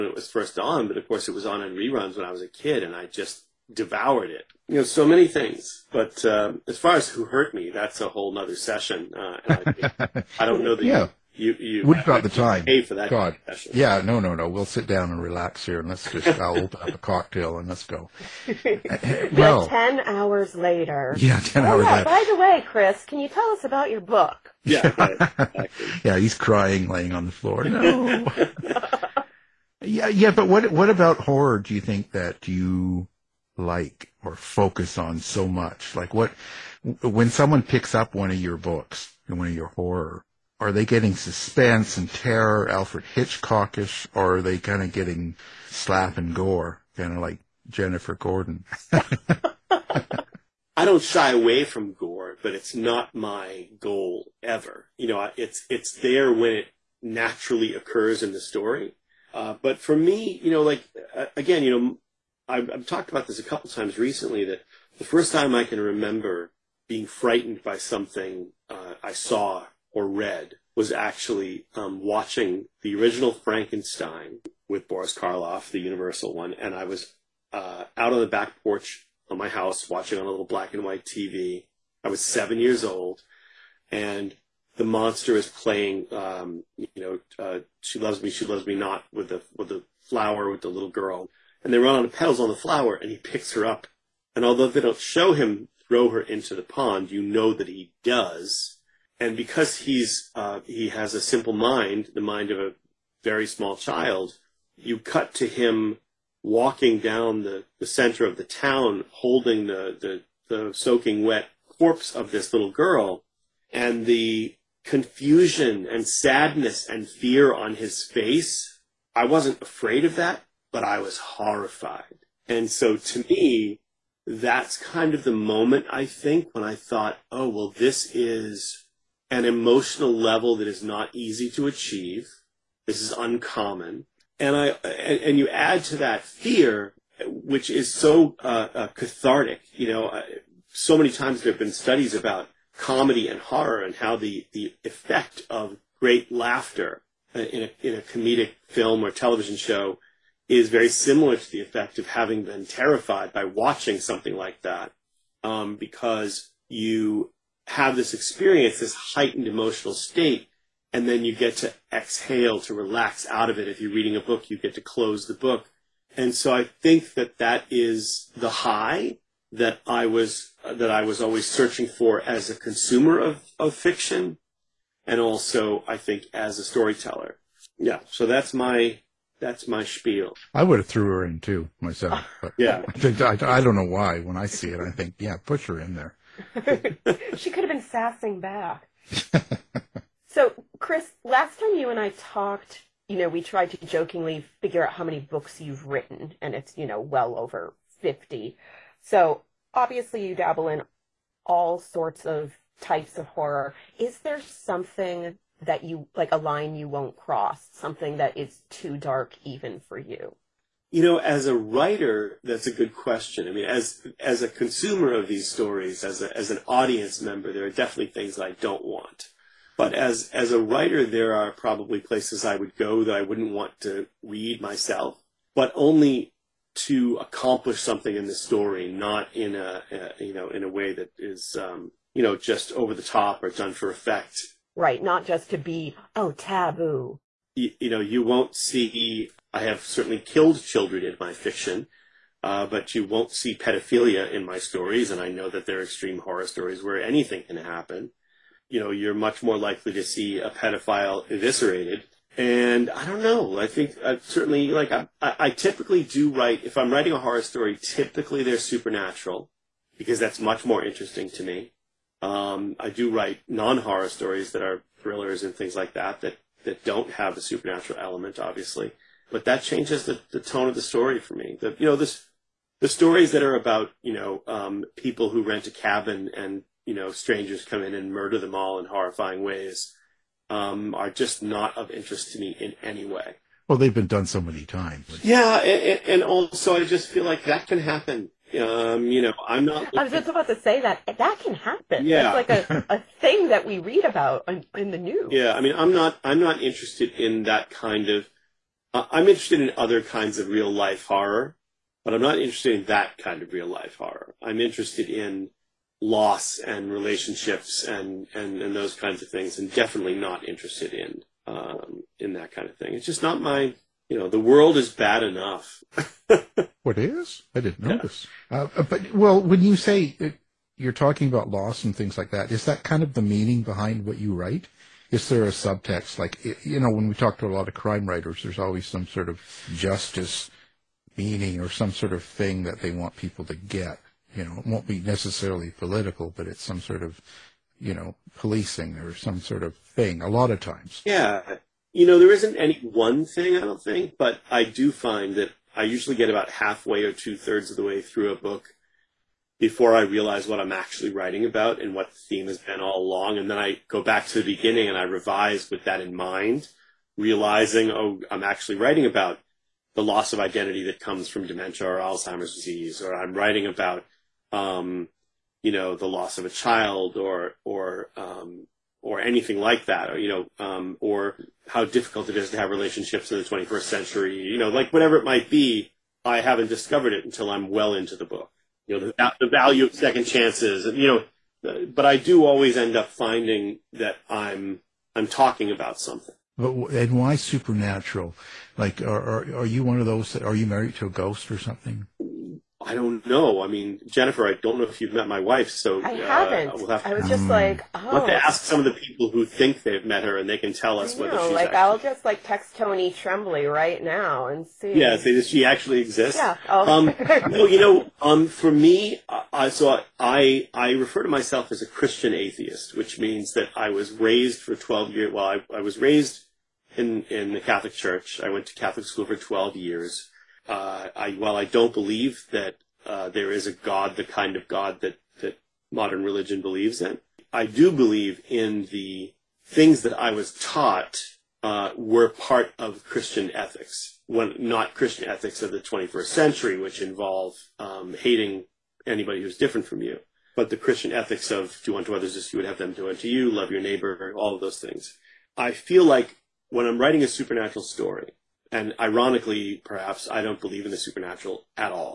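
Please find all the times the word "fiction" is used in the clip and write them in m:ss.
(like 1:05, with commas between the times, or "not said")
2:53, 4:01.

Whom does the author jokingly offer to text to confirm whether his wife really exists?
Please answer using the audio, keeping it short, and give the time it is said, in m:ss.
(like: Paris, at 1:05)
Tony Tremblay, at 6:42.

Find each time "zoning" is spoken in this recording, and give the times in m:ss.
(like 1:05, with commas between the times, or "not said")
not said.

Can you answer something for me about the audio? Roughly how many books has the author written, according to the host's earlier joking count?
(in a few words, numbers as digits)
well over 50.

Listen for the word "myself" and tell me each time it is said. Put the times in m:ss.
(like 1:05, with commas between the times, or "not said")
3:01, 3:44, 6:51.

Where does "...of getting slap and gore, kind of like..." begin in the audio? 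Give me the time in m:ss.
0:44.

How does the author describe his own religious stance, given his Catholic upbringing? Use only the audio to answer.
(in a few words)
Christian atheist.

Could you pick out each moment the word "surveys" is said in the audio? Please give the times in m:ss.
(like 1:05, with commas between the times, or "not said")
not said.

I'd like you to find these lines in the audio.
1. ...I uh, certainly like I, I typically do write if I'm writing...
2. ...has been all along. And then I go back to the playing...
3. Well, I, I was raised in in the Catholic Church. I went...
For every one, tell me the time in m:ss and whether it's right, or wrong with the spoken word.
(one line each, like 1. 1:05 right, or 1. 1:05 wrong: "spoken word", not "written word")
1. 4:14 right
2. 5:52 wrong: "beginning", not "playing"
3. 6:55 right.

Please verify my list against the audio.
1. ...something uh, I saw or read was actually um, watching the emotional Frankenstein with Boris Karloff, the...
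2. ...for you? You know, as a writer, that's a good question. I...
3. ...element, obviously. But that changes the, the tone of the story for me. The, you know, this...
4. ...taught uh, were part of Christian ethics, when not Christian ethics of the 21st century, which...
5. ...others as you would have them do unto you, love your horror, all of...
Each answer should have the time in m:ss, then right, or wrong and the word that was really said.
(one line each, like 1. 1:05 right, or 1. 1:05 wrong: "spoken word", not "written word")
1. 1:07 wrong: "original", not "emotional"
2. 3:29 right
3. 4:27 right
4. 7:10 right
5. 7:22 wrong: "neighbor", not "horror".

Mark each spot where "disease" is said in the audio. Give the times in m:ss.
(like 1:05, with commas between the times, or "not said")
6:02.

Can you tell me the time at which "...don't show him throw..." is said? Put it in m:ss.
1:34.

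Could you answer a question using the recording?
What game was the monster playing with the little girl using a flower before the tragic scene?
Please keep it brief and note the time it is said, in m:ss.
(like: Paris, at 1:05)
She Loves Me, She Loves Me Not, at 1:27.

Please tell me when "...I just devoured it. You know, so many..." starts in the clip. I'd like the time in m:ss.
0:02.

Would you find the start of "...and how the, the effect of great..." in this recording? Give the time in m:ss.
2:23.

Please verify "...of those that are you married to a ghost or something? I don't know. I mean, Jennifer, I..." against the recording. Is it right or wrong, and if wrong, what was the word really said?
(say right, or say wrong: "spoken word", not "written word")
right.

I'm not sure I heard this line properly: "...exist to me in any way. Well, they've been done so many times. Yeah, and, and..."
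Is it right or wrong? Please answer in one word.
wrong.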